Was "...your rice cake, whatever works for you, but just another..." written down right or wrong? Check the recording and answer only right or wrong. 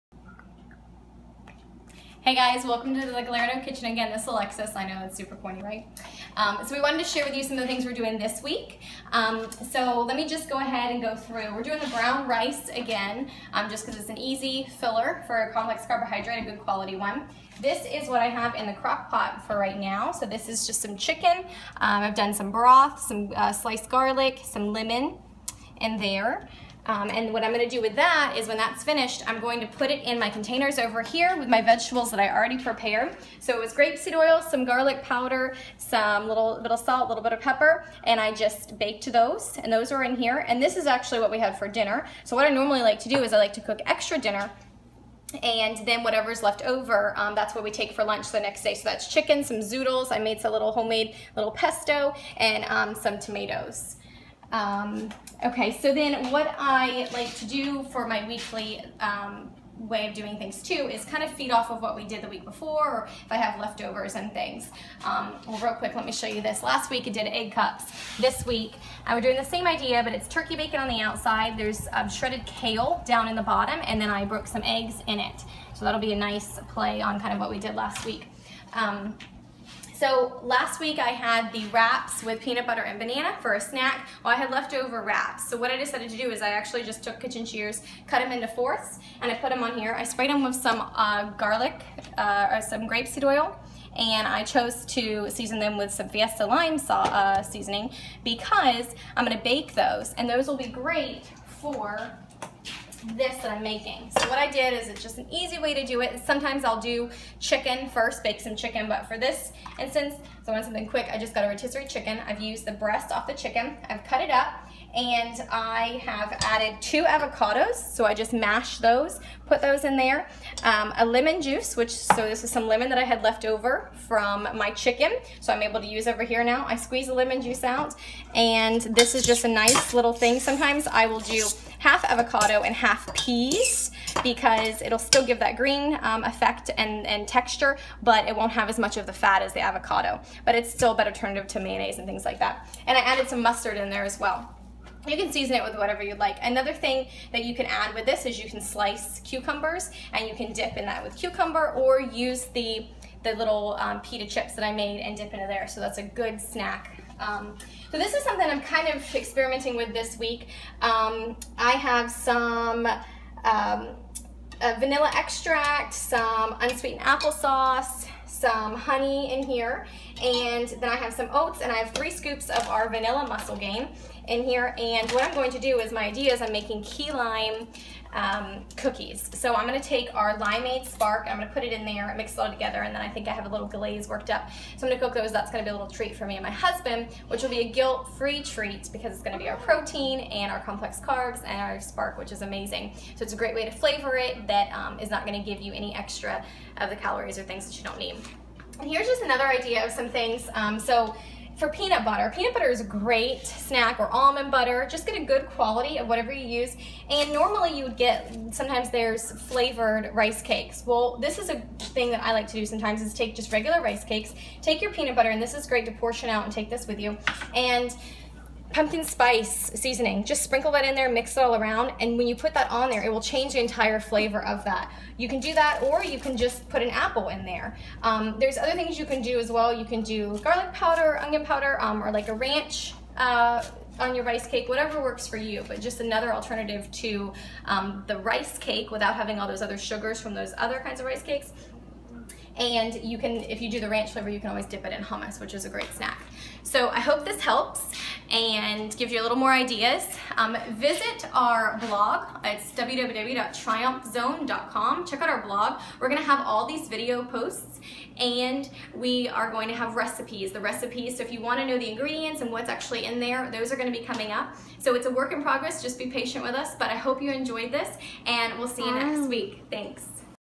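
right.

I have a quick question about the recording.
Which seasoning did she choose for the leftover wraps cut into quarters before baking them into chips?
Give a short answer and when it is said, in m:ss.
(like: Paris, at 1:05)
Fiesta lime, at 1:36.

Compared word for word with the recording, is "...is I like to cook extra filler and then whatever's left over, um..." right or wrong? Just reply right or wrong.
wrong.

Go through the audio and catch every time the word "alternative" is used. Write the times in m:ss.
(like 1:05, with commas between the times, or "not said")
2:21, 3:56.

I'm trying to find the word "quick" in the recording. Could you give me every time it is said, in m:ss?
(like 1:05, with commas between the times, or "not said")
1:05, 1:50.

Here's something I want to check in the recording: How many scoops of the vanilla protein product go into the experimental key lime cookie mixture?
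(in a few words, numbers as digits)
3.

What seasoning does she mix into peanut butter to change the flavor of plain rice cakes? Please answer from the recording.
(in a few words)
pumpkin spice.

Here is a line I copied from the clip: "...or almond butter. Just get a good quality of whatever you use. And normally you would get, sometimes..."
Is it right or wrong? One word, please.
right.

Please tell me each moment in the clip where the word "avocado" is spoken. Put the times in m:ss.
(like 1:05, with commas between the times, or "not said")
1:57, 2:12, 2:19.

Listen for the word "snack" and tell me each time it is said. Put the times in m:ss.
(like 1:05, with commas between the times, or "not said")
1:23, 2:36, 3:23, 4:05.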